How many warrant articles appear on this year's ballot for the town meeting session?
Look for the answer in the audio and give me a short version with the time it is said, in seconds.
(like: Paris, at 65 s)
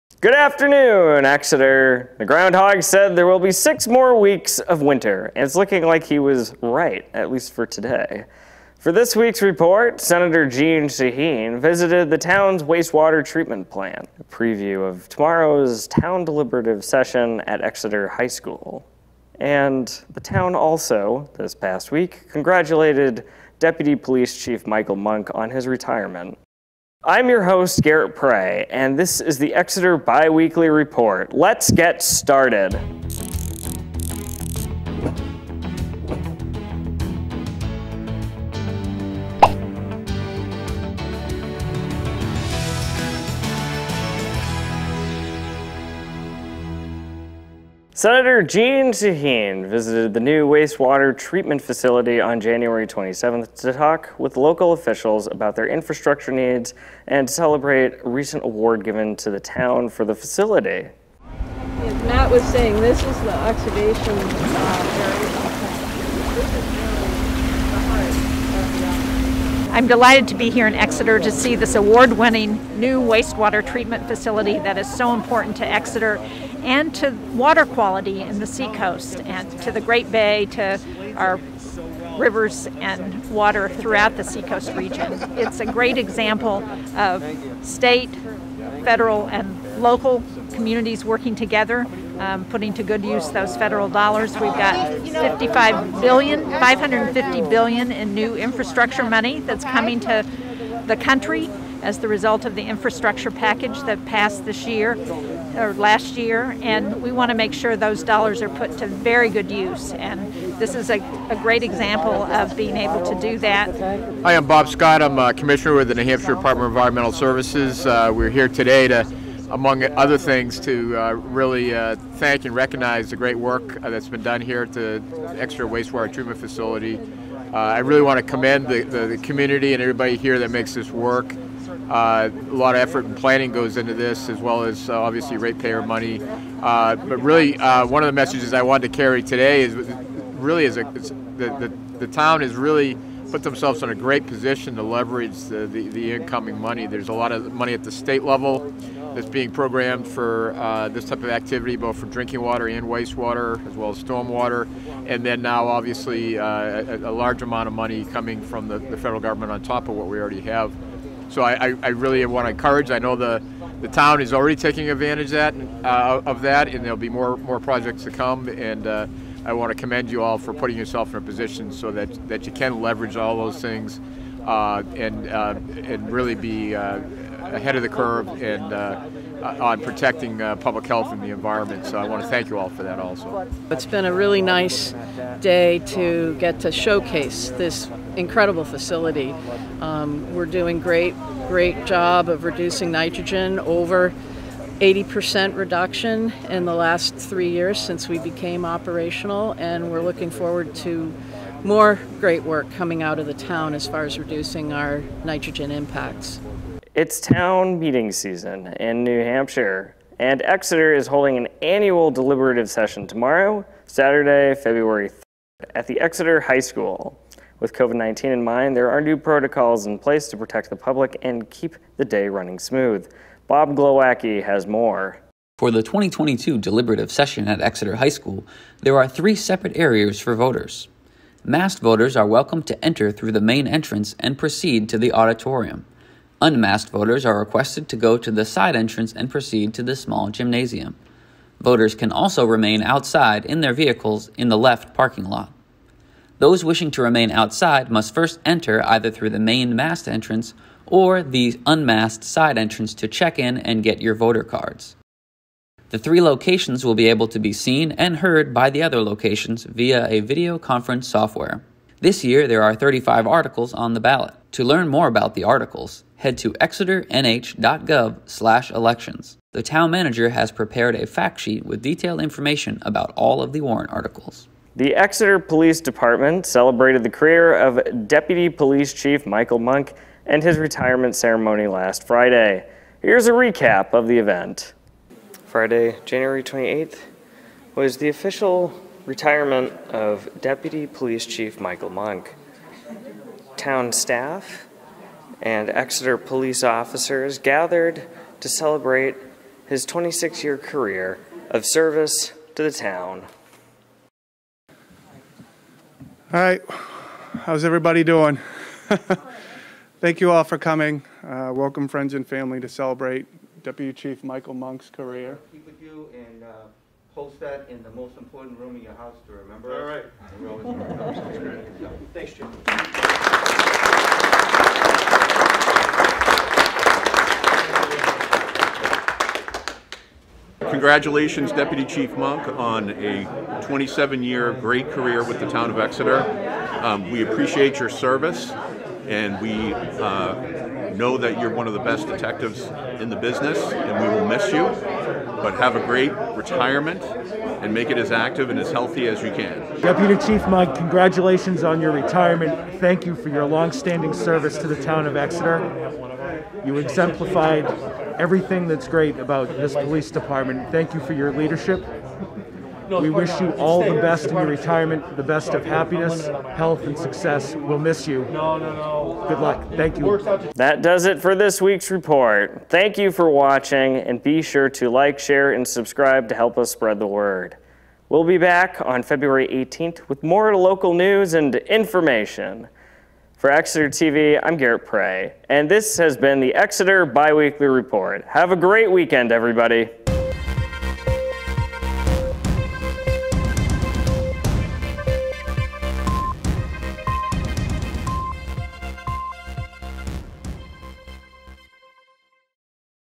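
35, at 262 s.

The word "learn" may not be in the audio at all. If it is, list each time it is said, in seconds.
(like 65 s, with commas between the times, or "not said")
264 s.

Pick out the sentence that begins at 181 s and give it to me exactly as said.
So I want to thank you all for that also.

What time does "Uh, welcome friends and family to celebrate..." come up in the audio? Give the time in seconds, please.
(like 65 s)
311 s.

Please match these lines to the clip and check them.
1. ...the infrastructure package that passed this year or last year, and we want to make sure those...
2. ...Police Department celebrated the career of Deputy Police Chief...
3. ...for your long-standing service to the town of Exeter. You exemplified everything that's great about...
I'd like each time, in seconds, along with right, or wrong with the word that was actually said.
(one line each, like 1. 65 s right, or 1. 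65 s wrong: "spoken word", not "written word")
1. 102 s right
2. 275 s right
3. 353 s right.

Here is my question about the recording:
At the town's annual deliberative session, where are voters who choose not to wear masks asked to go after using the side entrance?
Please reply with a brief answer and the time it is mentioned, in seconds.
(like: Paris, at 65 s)
the small gymnasium, at 239 s.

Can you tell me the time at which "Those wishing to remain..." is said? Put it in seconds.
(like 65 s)
246 s.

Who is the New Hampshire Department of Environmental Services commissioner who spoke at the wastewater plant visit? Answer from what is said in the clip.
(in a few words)
Bob Scott.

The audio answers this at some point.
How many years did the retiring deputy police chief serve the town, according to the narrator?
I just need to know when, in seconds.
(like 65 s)
299 s.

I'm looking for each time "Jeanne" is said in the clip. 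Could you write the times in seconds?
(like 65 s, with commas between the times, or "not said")
10 s, 48 s.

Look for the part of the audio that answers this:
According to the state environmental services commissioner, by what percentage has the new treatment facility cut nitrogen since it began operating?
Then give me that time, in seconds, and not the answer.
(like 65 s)
193 s.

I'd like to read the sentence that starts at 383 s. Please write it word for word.
For Exeter TV, I'm Garrett Prey, and this has been the Exeter Biweekly Report.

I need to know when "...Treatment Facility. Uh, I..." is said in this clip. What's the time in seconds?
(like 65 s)
126 s.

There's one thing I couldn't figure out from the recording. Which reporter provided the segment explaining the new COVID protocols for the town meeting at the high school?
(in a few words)
Bob Glowacki.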